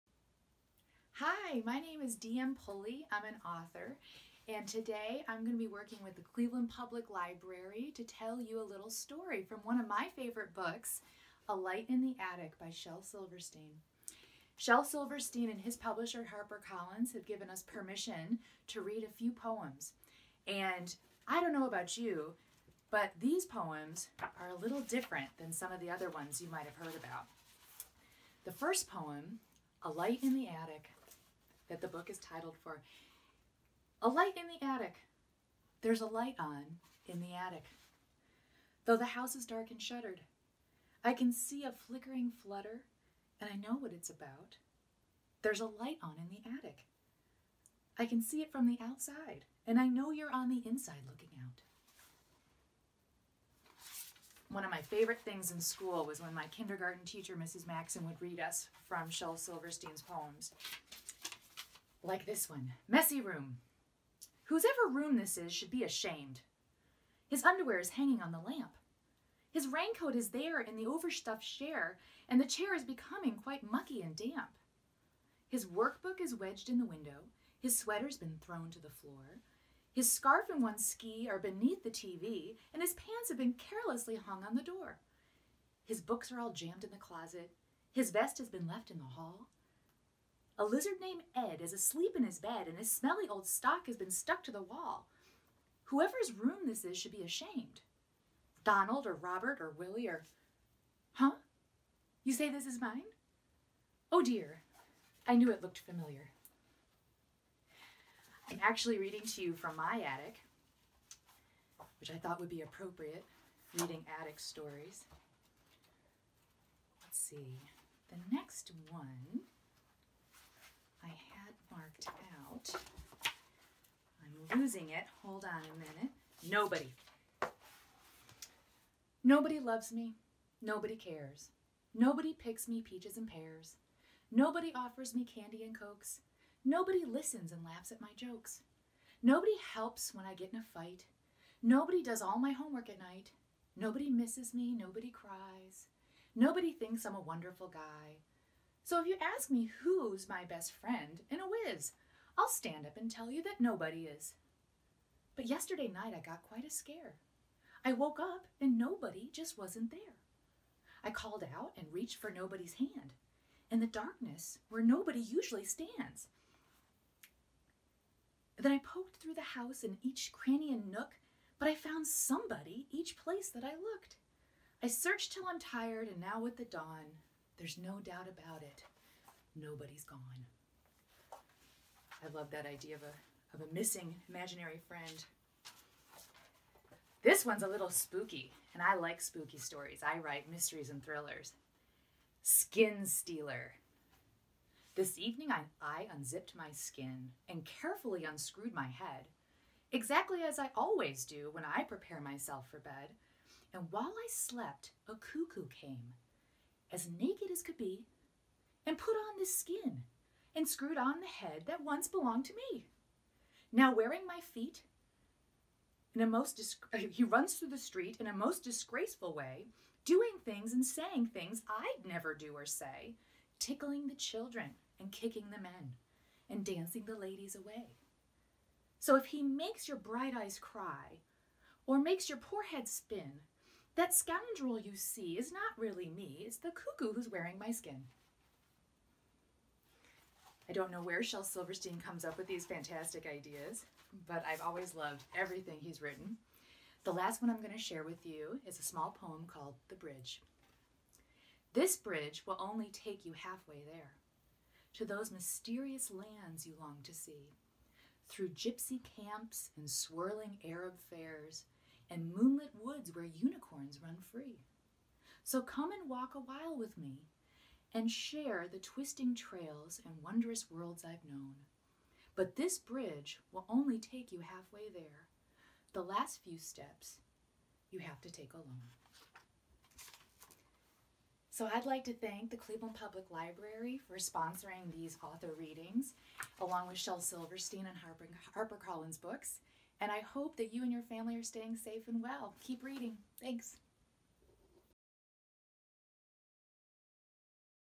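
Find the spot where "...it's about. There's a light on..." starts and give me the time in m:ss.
0:43.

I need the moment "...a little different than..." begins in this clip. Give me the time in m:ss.
0:24.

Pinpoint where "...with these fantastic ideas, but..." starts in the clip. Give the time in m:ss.
4:02.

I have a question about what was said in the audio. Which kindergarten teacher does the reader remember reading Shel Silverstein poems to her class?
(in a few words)
Mrs. Maxon.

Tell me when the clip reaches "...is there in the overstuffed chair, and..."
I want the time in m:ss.
1:10.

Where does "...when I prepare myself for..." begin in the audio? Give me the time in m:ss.
3:21.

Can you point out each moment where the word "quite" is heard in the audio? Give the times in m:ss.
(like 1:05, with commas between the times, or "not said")
1:13, 2:36.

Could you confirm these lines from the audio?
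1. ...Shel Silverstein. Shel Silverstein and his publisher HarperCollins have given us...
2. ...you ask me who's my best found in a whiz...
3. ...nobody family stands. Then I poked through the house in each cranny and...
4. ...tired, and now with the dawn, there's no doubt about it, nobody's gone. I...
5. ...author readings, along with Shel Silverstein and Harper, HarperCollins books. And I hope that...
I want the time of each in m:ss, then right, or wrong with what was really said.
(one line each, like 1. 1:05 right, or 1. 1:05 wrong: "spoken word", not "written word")
1. 0:12 right
2. 2:29 wrong: "friend", not "found"
3. 2:44 wrong: "usually", not "family"
4. 2:55 right
5. 4:45 right.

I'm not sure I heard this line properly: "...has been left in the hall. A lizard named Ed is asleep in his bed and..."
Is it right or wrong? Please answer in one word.
right.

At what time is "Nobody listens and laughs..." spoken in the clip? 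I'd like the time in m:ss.
2:16.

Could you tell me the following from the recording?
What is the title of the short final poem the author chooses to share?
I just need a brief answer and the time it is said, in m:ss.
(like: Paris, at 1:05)
The Bridge, at 4:09.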